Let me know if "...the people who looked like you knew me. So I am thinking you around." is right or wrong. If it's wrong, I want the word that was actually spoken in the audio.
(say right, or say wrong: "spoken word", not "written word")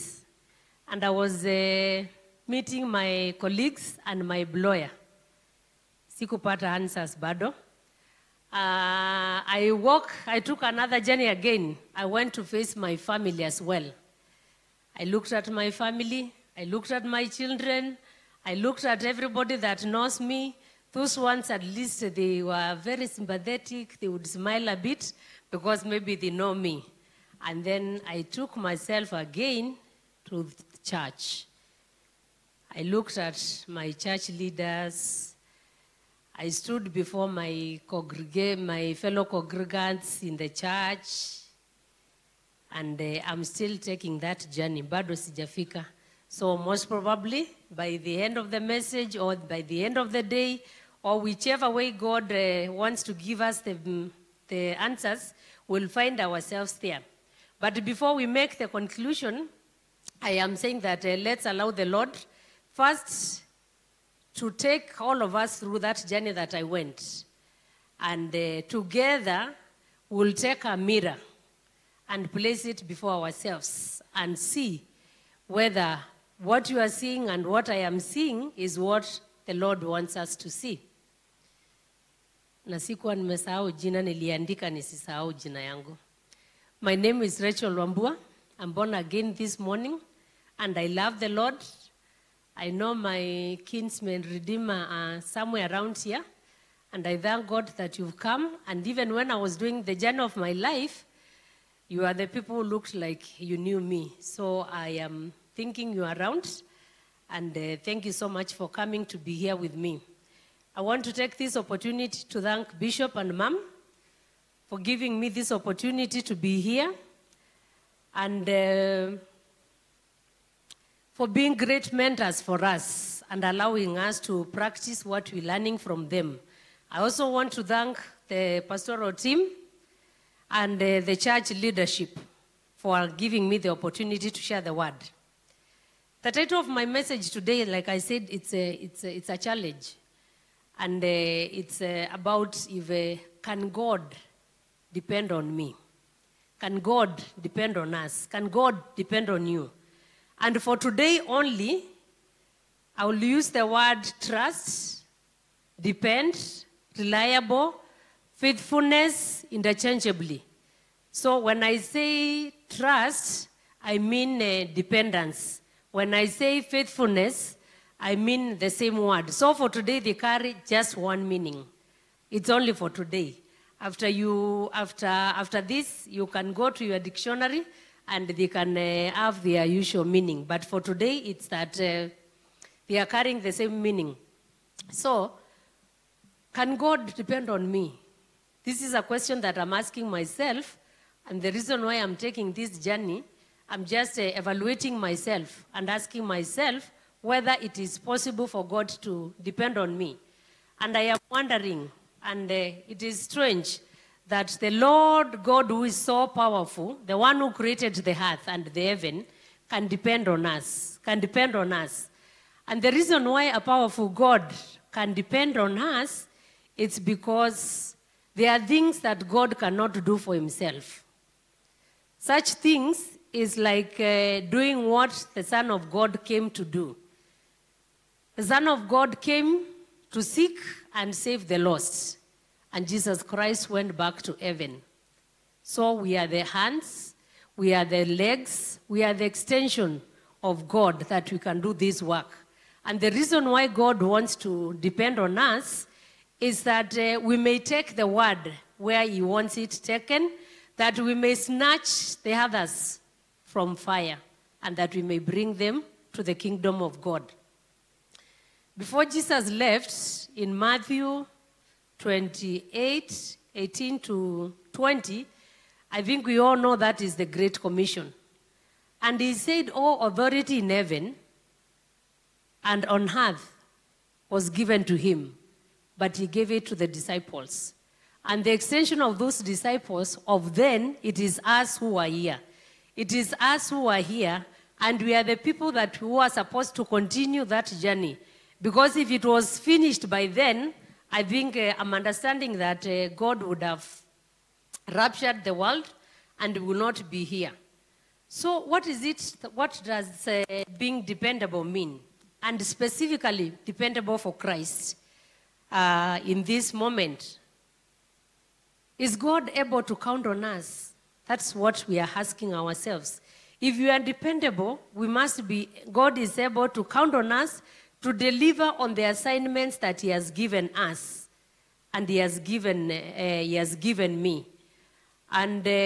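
right.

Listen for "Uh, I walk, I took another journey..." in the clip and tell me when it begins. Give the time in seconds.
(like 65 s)
8 s.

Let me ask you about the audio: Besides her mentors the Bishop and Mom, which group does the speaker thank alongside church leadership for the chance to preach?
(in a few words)
the pastoral team.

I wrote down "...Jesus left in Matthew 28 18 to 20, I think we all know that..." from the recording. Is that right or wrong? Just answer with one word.
right.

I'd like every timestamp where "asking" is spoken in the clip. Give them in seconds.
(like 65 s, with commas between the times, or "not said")
189 s, 195 s, 312 s.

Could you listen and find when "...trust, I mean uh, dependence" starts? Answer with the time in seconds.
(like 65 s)
162 s.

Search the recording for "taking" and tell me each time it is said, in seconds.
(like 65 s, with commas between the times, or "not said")
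43 s, 192 s.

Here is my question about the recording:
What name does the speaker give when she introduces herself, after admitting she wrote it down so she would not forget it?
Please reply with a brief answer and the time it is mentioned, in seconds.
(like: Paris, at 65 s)
Rachel Wambua, at 87 s.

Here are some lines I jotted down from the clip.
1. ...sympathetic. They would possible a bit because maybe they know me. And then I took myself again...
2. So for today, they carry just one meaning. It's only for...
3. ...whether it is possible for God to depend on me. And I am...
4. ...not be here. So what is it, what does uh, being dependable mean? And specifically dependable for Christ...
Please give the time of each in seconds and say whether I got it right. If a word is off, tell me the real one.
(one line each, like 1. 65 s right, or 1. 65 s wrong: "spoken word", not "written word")
1. 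23 s wrong: "smile", not "possible"
2. 169 s right
3. 197 s right
4. 296 s right.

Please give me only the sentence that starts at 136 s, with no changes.
The title of my message today, like I said, it's a, it's a, it's a challenge.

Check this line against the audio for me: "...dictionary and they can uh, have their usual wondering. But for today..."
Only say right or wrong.
wrong.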